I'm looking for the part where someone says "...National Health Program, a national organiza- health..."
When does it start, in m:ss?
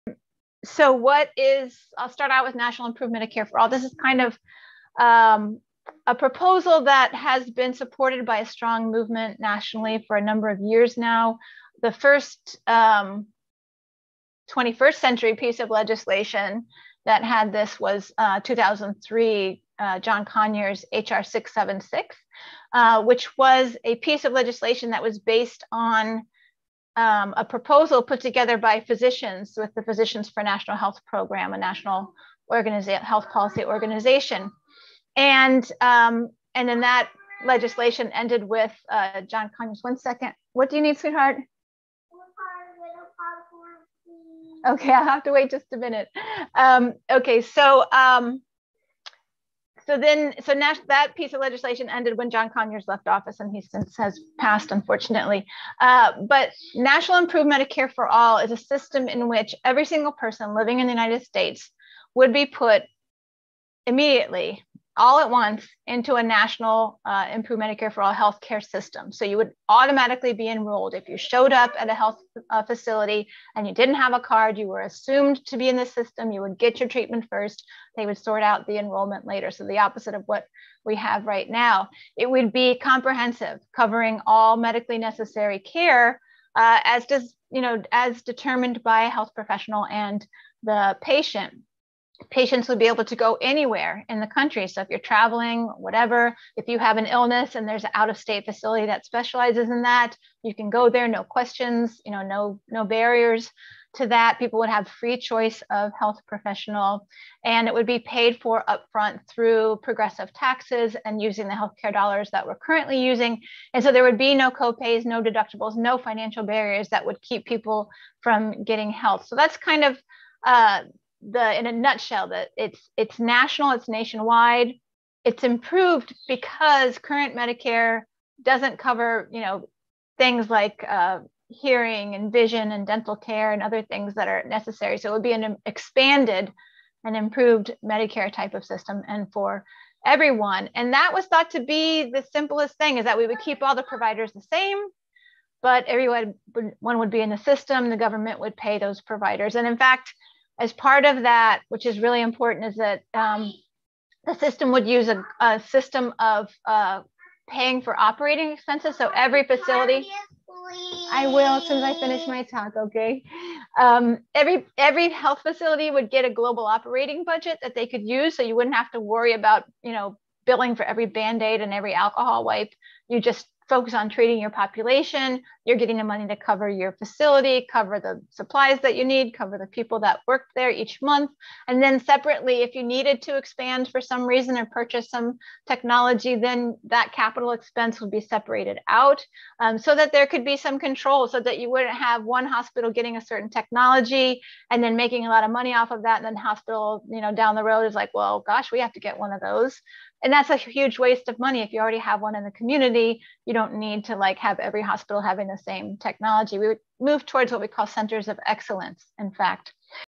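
0:30.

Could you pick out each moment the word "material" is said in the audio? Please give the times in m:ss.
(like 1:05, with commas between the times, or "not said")
not said.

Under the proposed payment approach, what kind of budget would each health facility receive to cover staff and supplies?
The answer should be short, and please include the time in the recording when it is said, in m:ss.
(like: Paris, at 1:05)
global operating budget, at 2:46.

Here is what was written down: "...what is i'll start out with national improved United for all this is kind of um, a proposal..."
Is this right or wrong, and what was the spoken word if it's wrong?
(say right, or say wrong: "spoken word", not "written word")
wrong: "Medicare", not "United".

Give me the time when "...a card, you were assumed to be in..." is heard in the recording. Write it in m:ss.
1:14.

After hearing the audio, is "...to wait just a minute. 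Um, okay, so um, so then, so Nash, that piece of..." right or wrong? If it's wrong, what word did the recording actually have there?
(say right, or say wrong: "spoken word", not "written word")
right.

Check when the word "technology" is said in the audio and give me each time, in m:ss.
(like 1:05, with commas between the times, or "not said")
3:05, 3:13, 3:25.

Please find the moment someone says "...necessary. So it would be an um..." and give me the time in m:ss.
2:14.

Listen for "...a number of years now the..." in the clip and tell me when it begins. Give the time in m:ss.
0:10.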